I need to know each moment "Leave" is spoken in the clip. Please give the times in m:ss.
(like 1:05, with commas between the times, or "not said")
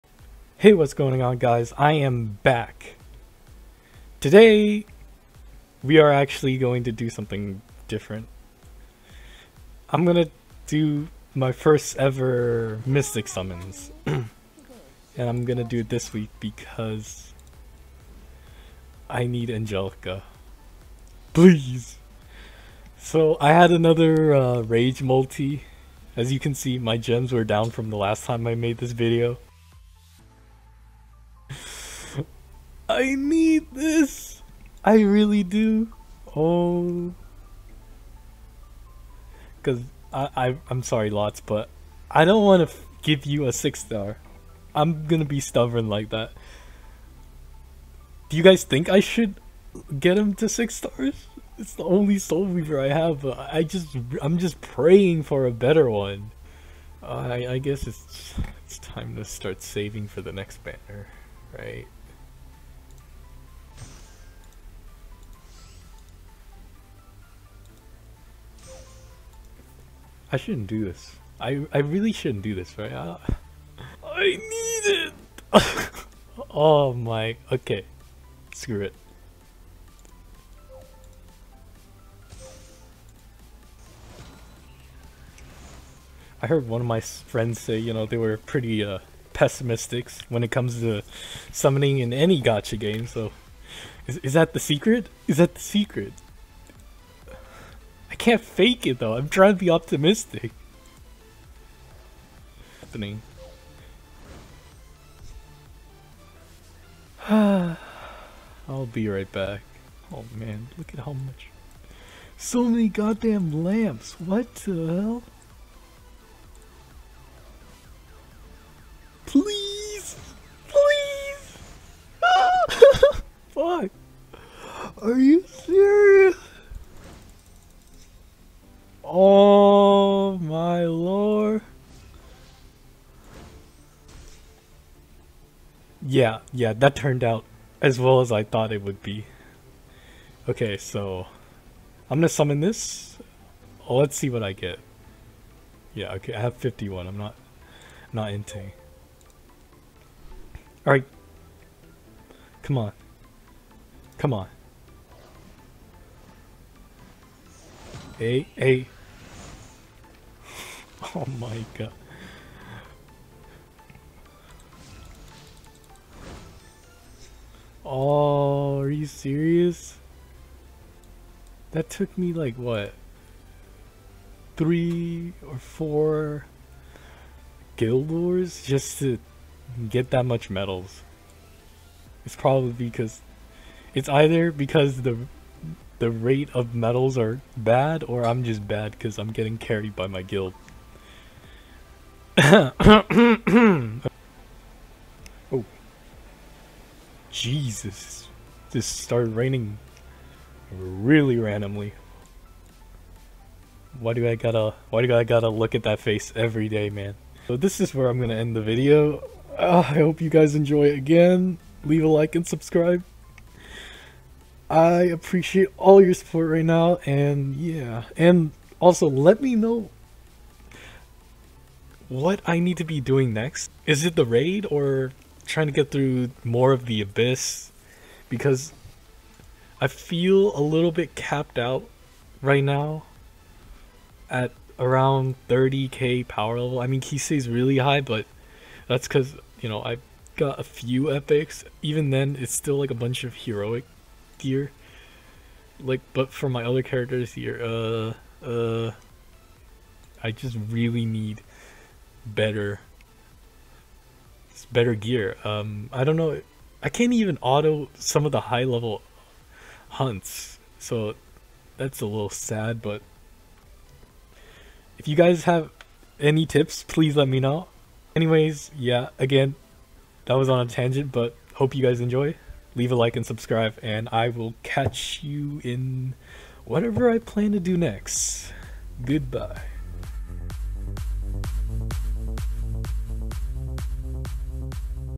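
3:31, 4:32.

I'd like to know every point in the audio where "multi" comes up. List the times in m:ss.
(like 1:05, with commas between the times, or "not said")
0:25.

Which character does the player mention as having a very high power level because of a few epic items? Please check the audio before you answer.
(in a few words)
Kise.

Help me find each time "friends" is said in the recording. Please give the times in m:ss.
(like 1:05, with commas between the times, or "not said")
1:27.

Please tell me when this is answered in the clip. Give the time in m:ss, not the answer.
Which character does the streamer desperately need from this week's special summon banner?
0:19.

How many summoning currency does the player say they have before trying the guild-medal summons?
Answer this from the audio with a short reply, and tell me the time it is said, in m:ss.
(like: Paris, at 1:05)
51, at 2:26.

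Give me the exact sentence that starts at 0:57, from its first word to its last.
Uh, I, I guess it's, it's time to start saving for the next banner, right?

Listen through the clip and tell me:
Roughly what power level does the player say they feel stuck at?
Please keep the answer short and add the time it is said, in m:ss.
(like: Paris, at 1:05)
30k, at 3:55.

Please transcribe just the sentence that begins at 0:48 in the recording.
Do you guys think I should get him to 6 stars?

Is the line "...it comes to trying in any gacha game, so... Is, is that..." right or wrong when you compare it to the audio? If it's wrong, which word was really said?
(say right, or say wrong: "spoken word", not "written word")
wrong: "summoning", not "trying".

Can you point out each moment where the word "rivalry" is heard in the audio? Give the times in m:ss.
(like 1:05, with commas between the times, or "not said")
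not said.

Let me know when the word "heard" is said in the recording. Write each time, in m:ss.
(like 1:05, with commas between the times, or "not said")
1:26.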